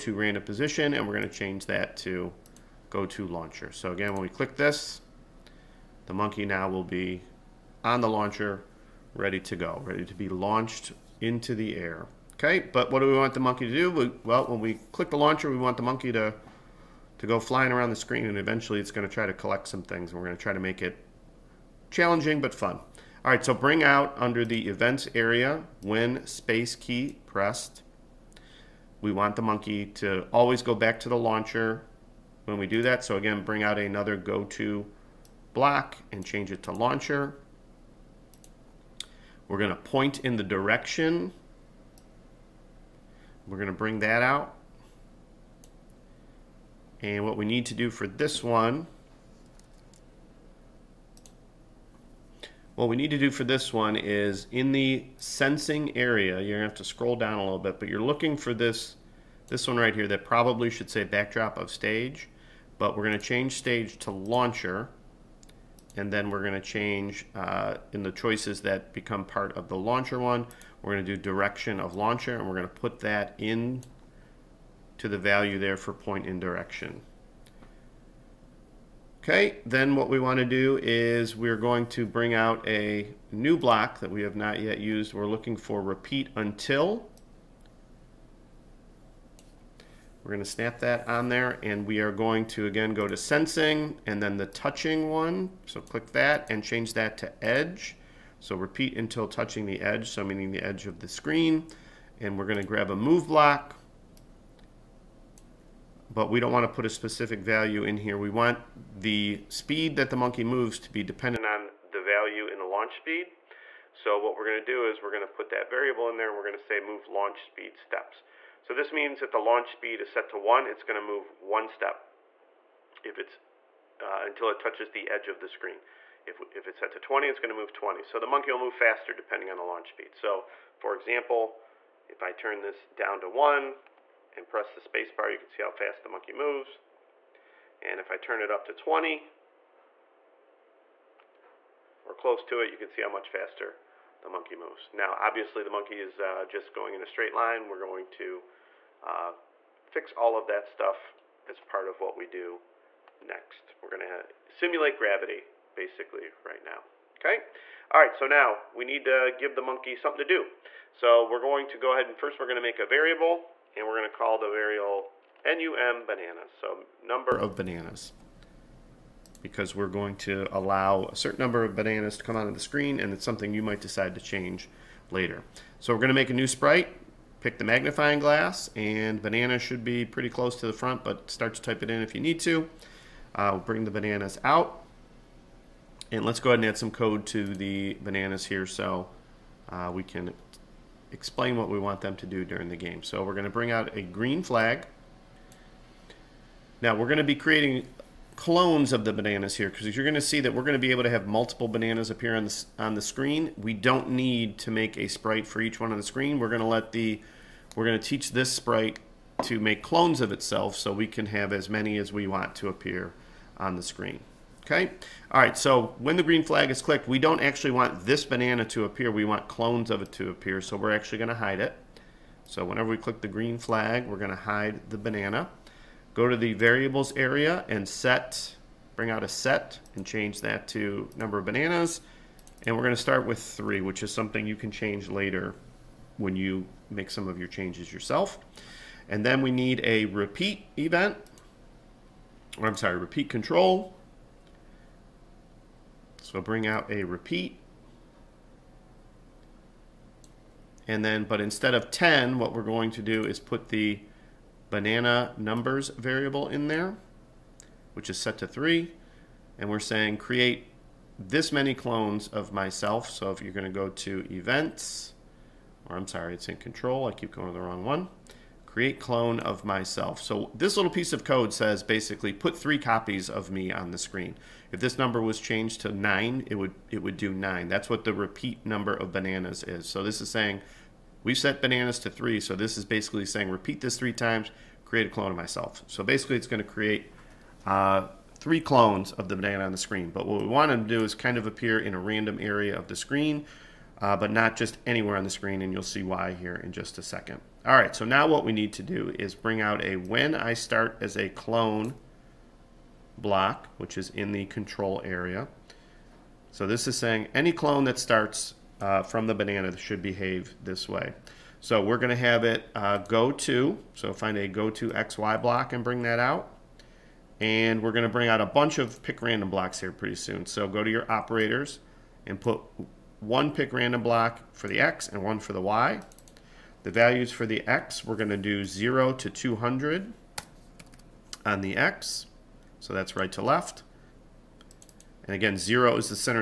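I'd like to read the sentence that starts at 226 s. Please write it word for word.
Go to the variables area and set, bring out a set and change that to number of bananas.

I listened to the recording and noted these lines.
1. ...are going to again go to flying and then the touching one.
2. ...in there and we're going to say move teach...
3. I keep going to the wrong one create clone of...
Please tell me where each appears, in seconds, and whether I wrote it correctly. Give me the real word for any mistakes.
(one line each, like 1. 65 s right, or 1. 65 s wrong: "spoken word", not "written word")
1. 91 s wrong: "sensing", not "flying"
2. 116 s wrong: "launch", not "teach"
3. 267 s right.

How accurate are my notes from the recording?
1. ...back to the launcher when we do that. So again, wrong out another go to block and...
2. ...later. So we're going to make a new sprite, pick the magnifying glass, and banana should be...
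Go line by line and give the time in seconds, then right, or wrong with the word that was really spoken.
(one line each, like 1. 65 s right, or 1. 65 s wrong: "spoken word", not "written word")
1. 30 s wrong: "bring", not "wrong"
2. 175 s right.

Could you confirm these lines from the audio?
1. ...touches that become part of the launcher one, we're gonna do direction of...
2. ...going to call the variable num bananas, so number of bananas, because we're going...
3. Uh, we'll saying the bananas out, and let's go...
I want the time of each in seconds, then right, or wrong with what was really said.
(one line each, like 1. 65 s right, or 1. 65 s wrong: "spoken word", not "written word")
1. 68 s wrong: "choices", not "touches"
2. 163 s right
3. 183 s wrong: "bring", not "saying".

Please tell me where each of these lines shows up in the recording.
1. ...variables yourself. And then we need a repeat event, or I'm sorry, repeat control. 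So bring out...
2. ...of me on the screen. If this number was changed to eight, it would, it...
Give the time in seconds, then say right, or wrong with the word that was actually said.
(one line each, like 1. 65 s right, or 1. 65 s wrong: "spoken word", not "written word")
1. 237 s wrong: "changes", not "variables"
2. 273 s wrong: "nine", not "eight".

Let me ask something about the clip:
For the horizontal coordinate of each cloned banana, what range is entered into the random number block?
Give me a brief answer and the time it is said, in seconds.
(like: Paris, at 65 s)
0 to 200, at 328 s.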